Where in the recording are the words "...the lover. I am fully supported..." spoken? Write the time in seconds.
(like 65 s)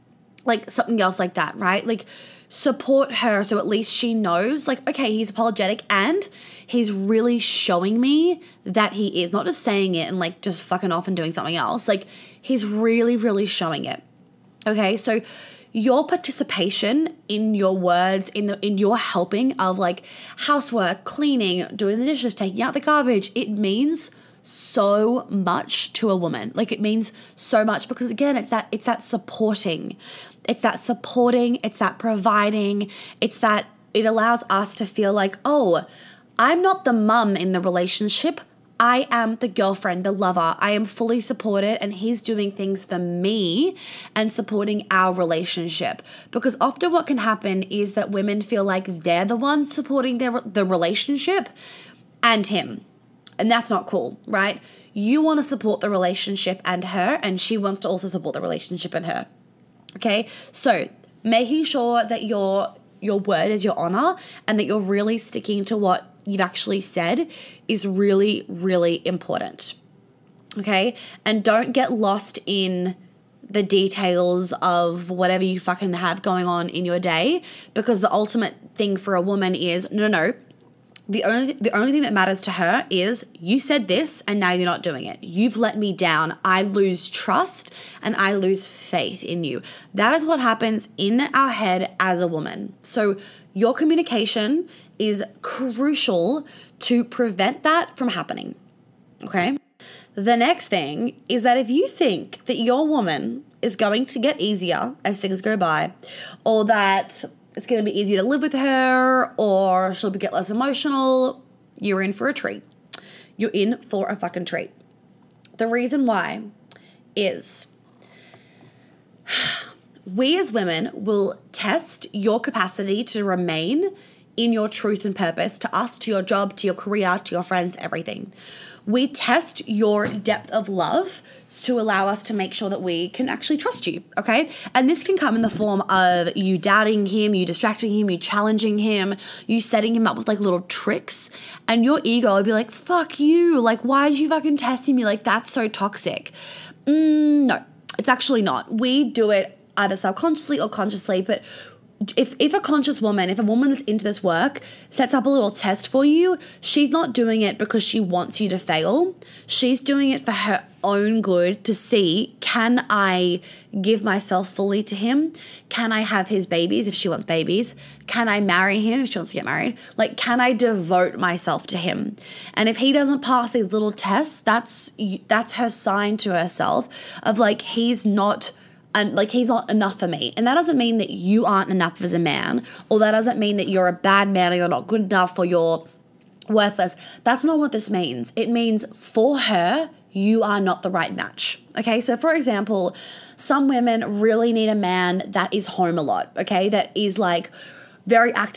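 40 s.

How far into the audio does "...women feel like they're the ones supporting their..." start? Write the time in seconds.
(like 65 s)
48 s.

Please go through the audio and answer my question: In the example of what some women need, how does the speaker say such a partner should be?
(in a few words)
home a lot.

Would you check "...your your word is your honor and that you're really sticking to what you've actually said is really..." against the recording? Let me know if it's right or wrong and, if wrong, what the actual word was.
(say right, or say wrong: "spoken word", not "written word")
right.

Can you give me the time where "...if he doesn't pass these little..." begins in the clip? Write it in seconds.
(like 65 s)
172 s.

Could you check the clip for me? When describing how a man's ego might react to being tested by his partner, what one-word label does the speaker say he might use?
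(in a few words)
toxic.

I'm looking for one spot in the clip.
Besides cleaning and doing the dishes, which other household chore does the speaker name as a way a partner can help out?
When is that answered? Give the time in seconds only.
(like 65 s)
22 s.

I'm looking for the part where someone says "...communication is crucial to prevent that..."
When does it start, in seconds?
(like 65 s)
93 s.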